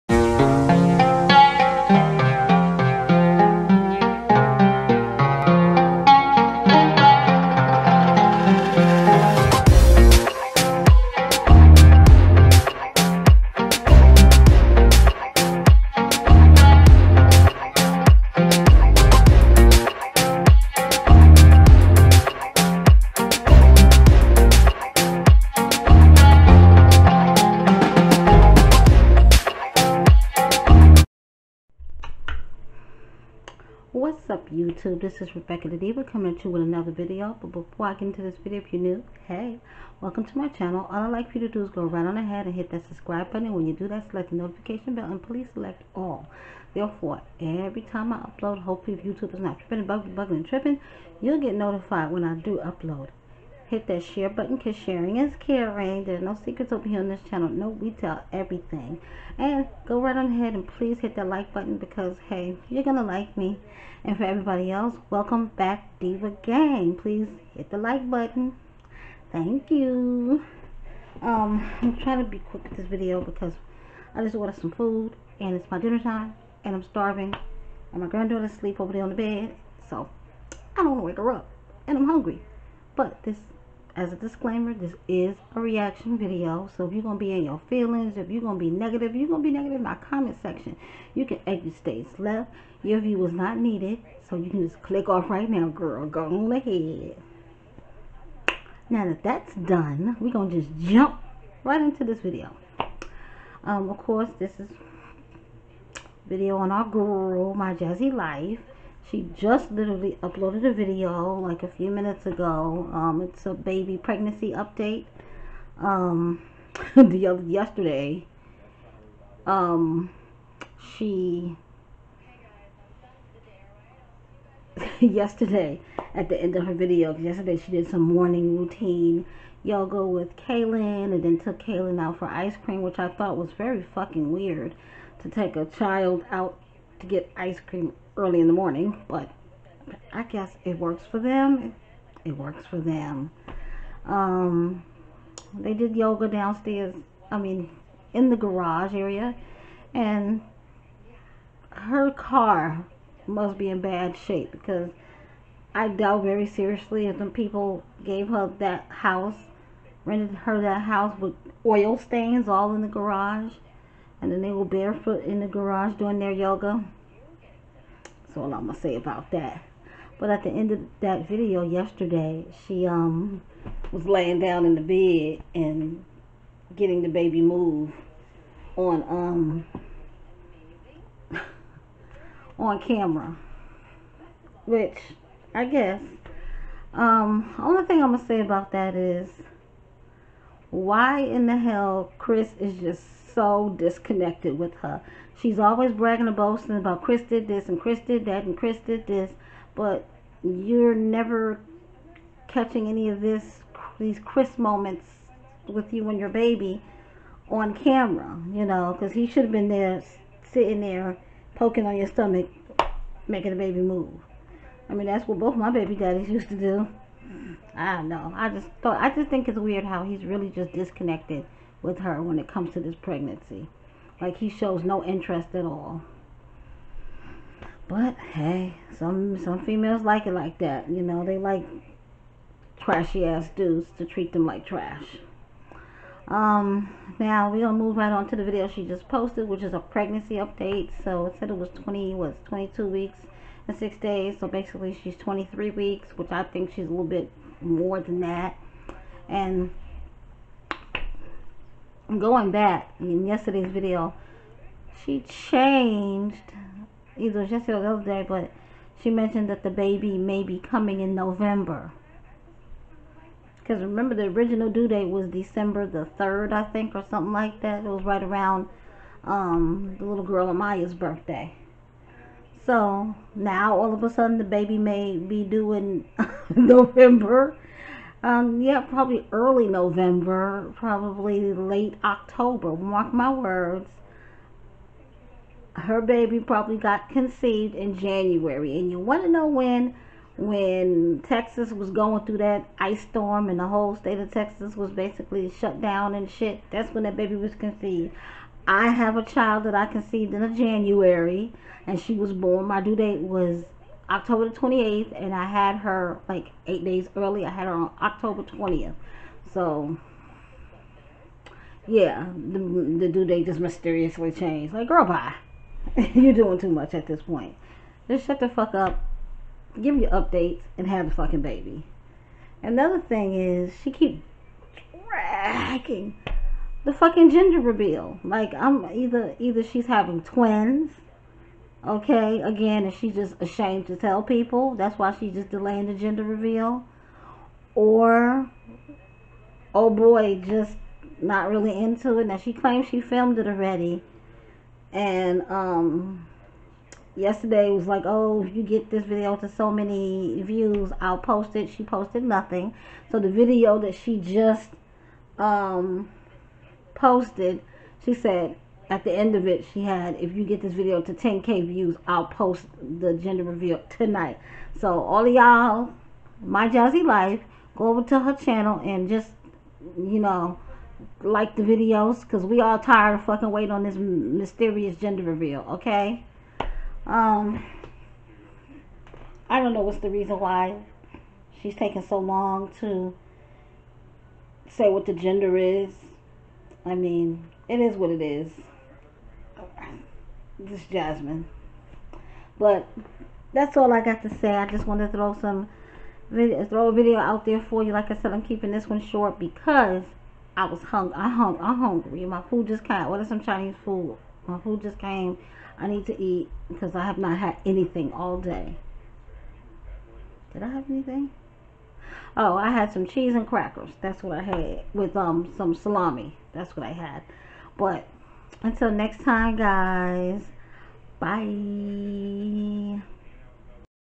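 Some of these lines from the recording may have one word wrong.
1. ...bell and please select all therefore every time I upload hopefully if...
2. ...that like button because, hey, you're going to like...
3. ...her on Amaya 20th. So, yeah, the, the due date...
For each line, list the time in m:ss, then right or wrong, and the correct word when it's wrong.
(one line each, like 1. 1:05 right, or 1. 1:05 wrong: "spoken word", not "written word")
1. 0:44 right
2. 1:01 right
3. 5:07 wrong: "October", not "Amaya".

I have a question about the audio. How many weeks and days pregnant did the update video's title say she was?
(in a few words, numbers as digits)
22 weeks and 6 days.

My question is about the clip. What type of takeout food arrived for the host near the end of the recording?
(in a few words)
Chinese food.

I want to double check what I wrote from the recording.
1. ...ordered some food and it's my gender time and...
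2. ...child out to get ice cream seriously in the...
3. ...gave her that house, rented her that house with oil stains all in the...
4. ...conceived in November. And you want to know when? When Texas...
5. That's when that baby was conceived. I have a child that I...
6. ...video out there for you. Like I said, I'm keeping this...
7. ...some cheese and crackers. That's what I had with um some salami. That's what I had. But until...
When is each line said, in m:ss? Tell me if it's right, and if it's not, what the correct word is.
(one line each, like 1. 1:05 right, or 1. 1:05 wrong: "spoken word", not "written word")
1. 1:14 wrong: "dinner", not "gender"
2. 2:15 wrong: "early", not "seriously"
3. 2:38 right
4. 4:47 wrong: "January", not "November"
5. 4:56 right
6. 6:36 right
7. 6:52 right.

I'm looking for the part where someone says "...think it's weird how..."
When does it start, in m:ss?
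3:39.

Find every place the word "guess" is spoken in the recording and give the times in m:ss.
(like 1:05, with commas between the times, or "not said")
2:20, 3:05.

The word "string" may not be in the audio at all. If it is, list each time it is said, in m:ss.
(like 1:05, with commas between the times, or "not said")
not said.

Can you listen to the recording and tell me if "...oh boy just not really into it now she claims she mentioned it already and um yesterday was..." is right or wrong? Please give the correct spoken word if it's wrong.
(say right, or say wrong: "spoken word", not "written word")
wrong: "filmed", not "mentioned".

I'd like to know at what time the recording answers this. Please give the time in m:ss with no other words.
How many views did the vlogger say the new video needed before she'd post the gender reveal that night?
6:01.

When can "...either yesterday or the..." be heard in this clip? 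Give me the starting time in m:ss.
4:17.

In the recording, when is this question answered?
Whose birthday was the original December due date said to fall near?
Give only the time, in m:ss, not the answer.
4:30.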